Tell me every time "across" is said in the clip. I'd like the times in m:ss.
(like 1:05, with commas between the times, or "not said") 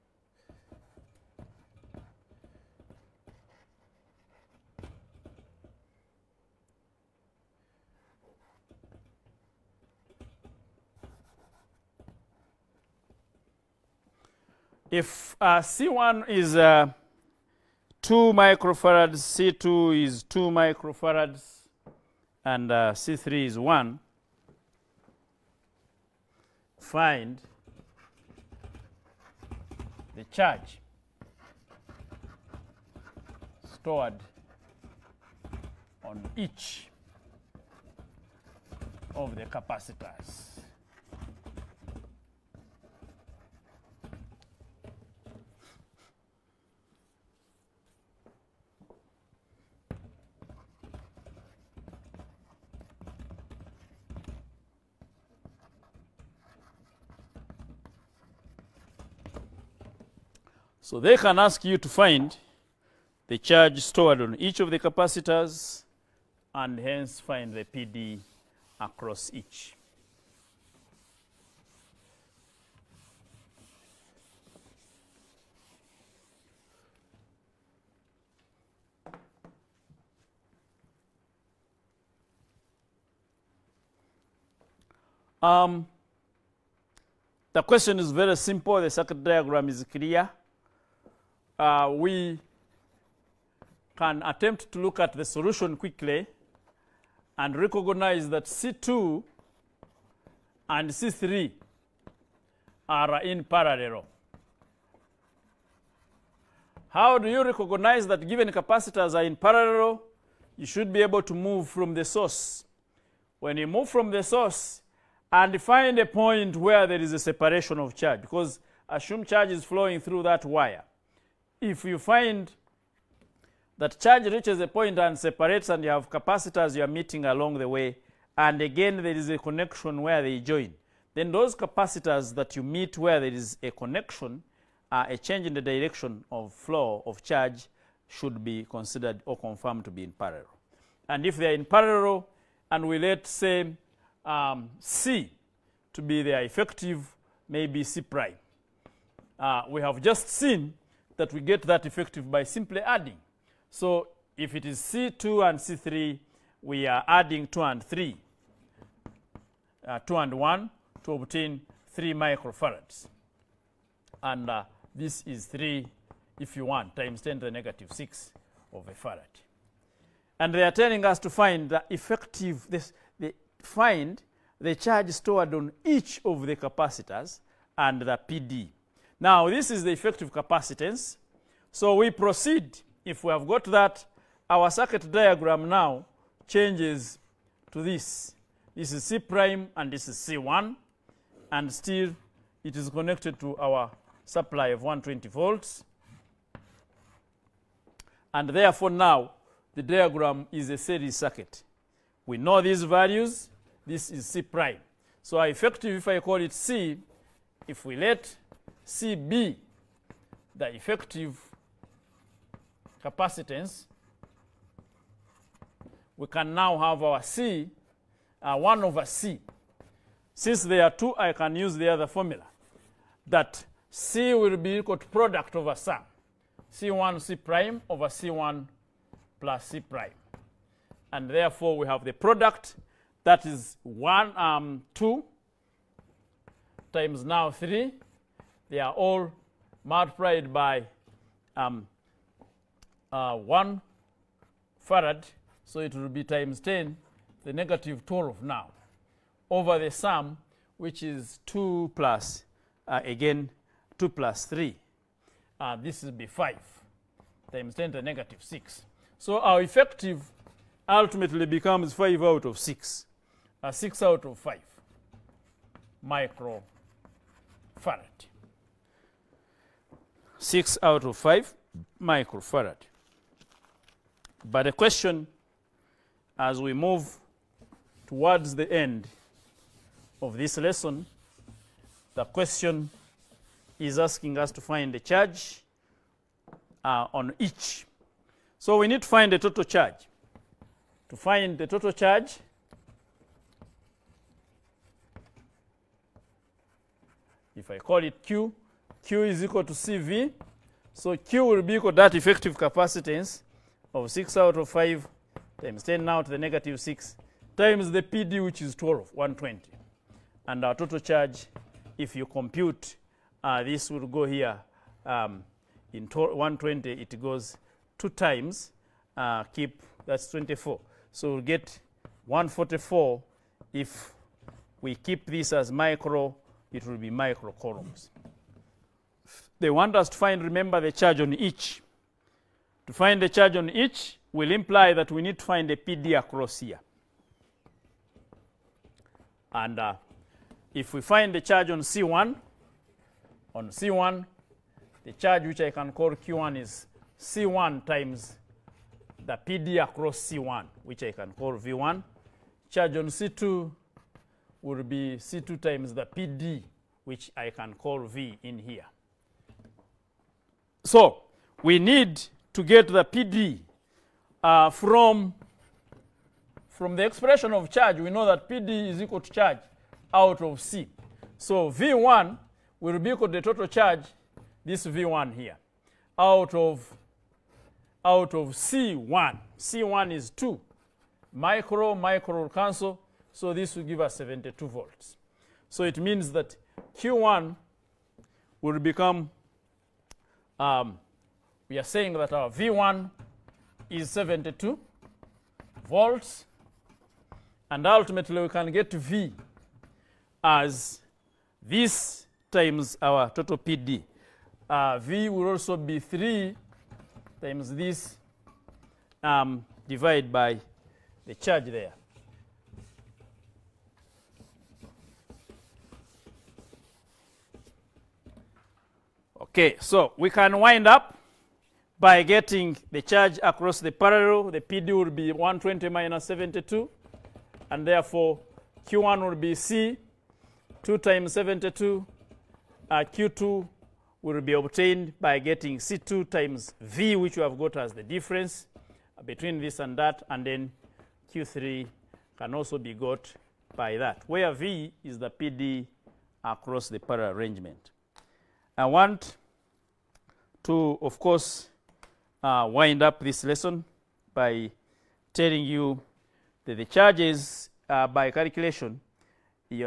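1:08, 5:36, 5:49, 7:03, 7:26.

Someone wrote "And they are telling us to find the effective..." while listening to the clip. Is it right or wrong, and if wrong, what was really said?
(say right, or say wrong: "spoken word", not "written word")
right.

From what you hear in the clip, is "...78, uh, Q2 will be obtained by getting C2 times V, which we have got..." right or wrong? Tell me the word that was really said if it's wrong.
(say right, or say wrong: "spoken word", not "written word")
wrong: "72", not "78".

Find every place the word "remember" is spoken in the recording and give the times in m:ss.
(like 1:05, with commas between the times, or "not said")
5:30.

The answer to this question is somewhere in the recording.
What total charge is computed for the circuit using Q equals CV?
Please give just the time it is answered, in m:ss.
5:22.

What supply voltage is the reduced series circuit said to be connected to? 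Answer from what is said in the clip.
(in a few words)
120 volts.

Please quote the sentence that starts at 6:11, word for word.
So V1 will be equal to the total charge, this V1 here, out of, out of C1.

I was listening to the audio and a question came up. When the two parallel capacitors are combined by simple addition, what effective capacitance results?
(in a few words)
3 microfarads.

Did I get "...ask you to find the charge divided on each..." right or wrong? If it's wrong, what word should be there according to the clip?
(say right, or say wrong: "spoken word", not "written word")
wrong: "stored", not "divided".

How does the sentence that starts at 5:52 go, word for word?
Charge on C2 will be C2 times the PD, which I can call V in here.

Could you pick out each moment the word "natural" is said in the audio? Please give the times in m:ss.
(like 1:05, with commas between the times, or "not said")
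not said.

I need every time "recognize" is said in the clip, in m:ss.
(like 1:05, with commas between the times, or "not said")
1:37, 1:47.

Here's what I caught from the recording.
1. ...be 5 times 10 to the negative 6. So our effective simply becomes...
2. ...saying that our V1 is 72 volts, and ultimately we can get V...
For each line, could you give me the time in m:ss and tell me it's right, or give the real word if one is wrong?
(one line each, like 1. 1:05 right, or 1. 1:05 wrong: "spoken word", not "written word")
1. 4:16 wrong: "ultimately", not "simply"
2. 6:31 right.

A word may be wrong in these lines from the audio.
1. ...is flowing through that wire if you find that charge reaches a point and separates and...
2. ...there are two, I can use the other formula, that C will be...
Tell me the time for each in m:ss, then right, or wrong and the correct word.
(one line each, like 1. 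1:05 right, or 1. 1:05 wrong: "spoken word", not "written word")
1. 1:59 right
2. 3:40 right.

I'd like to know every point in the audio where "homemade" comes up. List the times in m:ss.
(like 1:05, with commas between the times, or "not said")
not said.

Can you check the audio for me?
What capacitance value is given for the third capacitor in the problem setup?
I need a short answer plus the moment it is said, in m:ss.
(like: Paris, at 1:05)
1 microfarad, at 0:22.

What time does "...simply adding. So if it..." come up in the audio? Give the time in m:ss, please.
2:32.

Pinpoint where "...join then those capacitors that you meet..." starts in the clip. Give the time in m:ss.
2:10.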